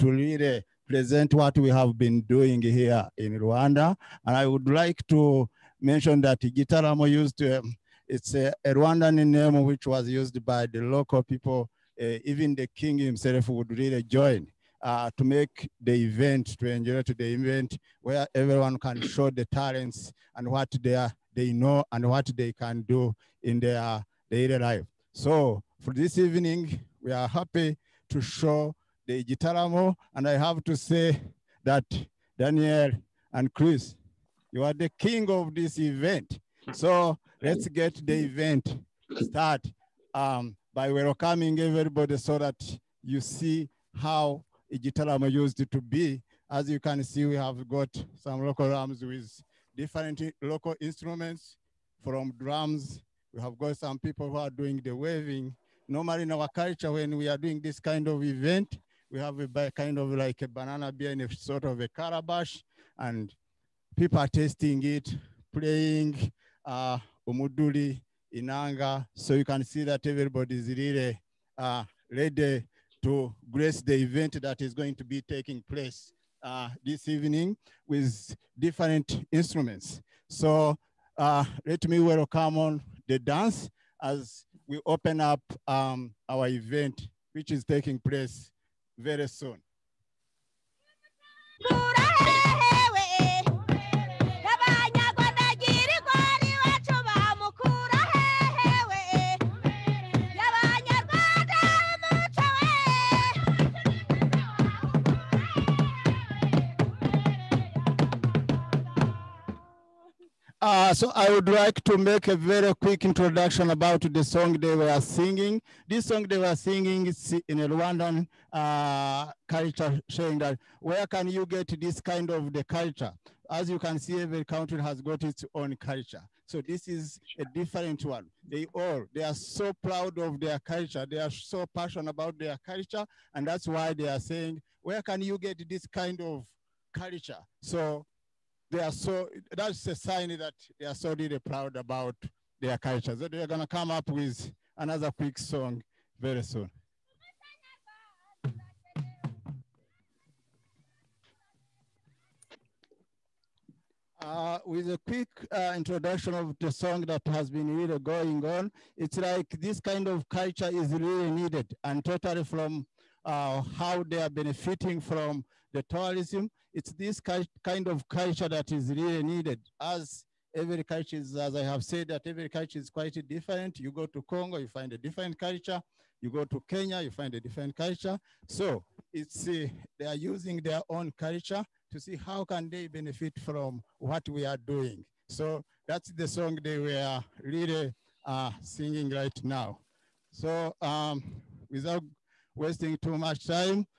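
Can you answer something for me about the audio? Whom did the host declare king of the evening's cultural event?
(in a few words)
Daniel and Chris.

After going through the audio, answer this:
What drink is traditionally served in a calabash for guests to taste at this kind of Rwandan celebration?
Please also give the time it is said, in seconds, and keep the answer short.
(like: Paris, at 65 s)
banana beer, at 60 s.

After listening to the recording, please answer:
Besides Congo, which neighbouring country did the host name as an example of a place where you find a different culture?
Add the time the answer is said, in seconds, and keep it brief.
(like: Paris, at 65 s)
Kenya, at 176 s.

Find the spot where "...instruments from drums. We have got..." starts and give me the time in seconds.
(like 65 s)
50 s.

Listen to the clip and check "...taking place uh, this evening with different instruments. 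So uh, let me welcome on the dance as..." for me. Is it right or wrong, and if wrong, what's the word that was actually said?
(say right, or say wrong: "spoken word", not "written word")
right.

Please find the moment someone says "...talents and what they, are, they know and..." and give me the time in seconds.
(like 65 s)
19 s.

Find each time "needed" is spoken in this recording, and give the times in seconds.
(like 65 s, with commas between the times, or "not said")
161 s, 169 s.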